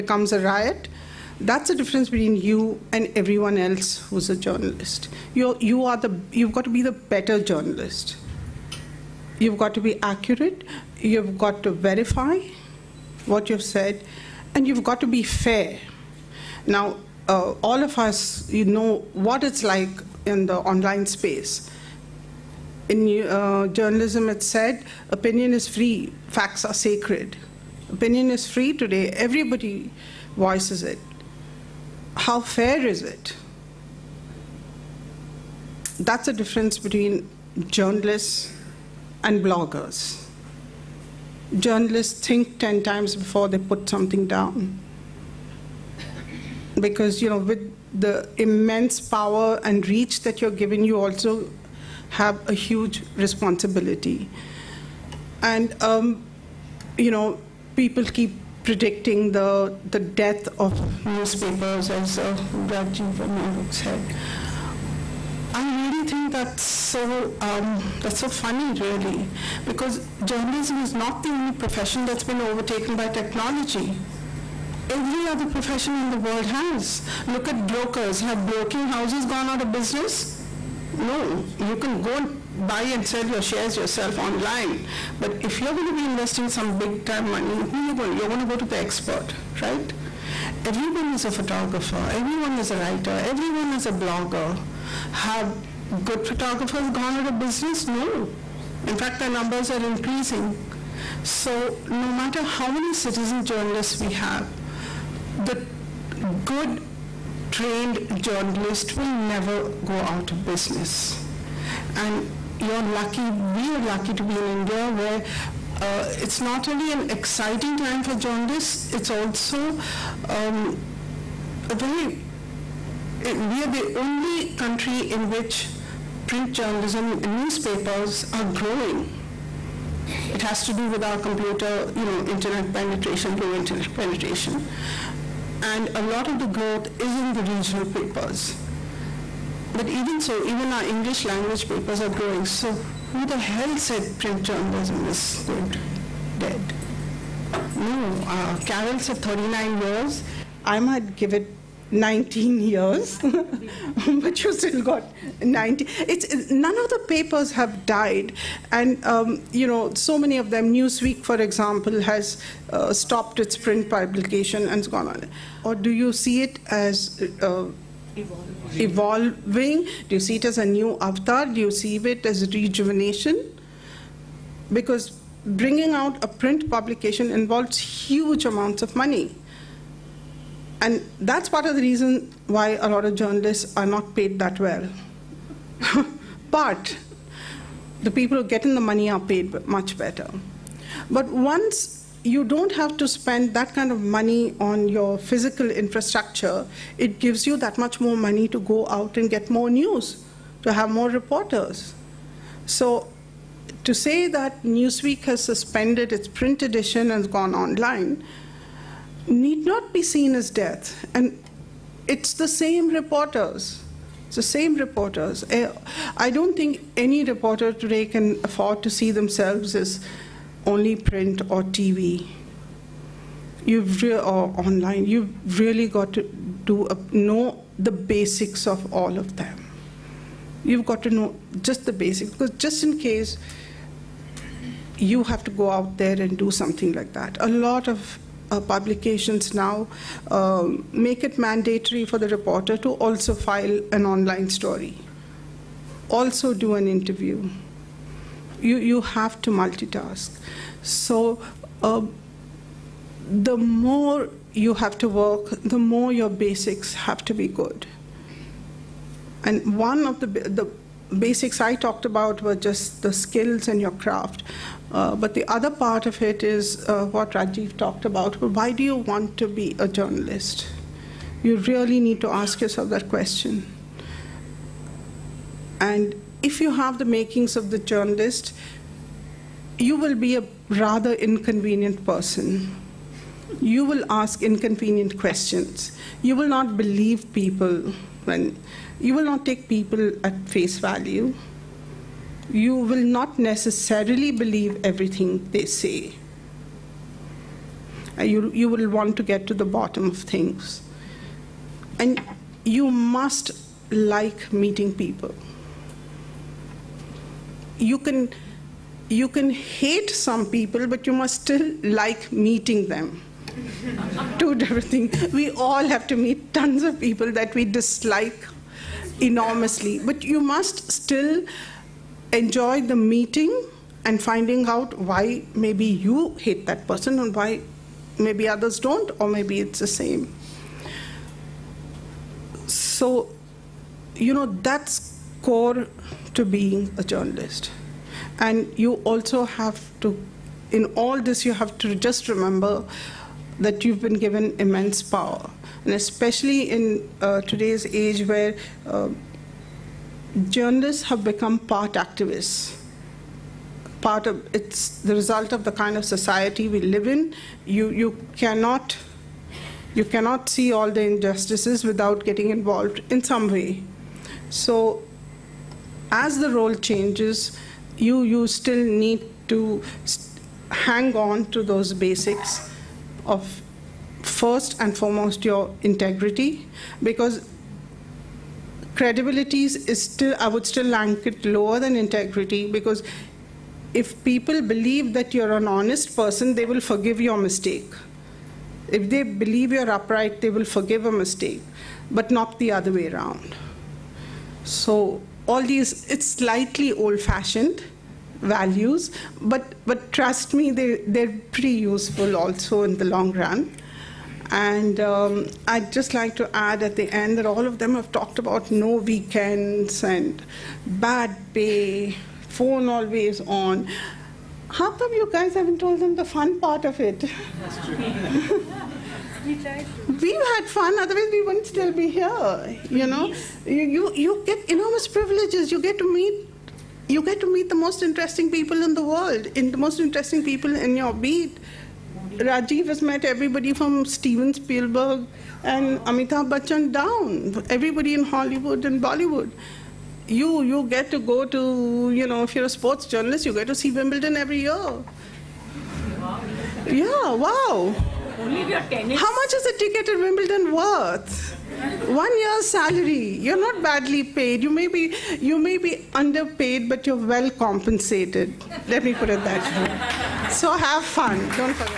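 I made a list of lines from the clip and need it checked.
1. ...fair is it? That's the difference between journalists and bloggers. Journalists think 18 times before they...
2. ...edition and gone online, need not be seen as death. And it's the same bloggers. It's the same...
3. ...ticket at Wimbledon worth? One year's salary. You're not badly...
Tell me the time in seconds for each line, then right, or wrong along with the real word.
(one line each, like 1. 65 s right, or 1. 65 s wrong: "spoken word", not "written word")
1. 32 s wrong: "10", not "18"
2. 206 s wrong: "reporters", not "bloggers"
3. 449 s right.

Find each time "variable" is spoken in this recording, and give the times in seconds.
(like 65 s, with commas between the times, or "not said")
not said.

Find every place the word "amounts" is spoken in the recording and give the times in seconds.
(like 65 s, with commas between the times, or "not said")
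178 s.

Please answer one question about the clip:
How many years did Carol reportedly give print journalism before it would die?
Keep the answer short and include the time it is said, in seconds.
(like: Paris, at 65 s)
39, at 149 s.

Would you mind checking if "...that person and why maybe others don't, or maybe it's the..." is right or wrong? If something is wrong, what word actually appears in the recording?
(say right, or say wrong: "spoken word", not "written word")
right.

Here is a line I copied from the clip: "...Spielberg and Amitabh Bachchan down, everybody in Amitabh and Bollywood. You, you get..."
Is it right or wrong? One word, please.
wrong.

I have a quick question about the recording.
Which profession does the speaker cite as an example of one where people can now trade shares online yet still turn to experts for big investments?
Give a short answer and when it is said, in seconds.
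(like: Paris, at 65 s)
Brokers, at 77 s.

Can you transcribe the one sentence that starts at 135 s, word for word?
And a lot of the growth is in the regional papers.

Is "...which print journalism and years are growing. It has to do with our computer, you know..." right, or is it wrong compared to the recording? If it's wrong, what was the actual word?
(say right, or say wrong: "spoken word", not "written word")
wrong: "newspapers", not "years".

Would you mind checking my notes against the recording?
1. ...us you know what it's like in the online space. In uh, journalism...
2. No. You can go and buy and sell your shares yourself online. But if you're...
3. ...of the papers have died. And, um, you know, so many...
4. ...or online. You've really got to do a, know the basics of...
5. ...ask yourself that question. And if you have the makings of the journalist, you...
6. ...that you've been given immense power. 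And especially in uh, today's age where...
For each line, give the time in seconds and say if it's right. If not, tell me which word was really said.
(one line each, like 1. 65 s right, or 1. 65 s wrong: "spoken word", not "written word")
1. 17 s right
2. 80 s right
3. 156 s right
4. 224 s right
5. 272 s right
6. 343 s right.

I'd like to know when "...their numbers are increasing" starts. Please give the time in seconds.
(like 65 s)
99 s.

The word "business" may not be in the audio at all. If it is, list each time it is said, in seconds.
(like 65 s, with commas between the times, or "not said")
79 s, 97 s, 110 s.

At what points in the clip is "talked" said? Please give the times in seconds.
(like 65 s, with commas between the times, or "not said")
261 s, 267 s, 408 s.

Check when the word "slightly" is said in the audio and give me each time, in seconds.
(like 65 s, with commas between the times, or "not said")
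396 s.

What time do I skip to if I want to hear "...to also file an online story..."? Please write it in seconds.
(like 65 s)
242 s.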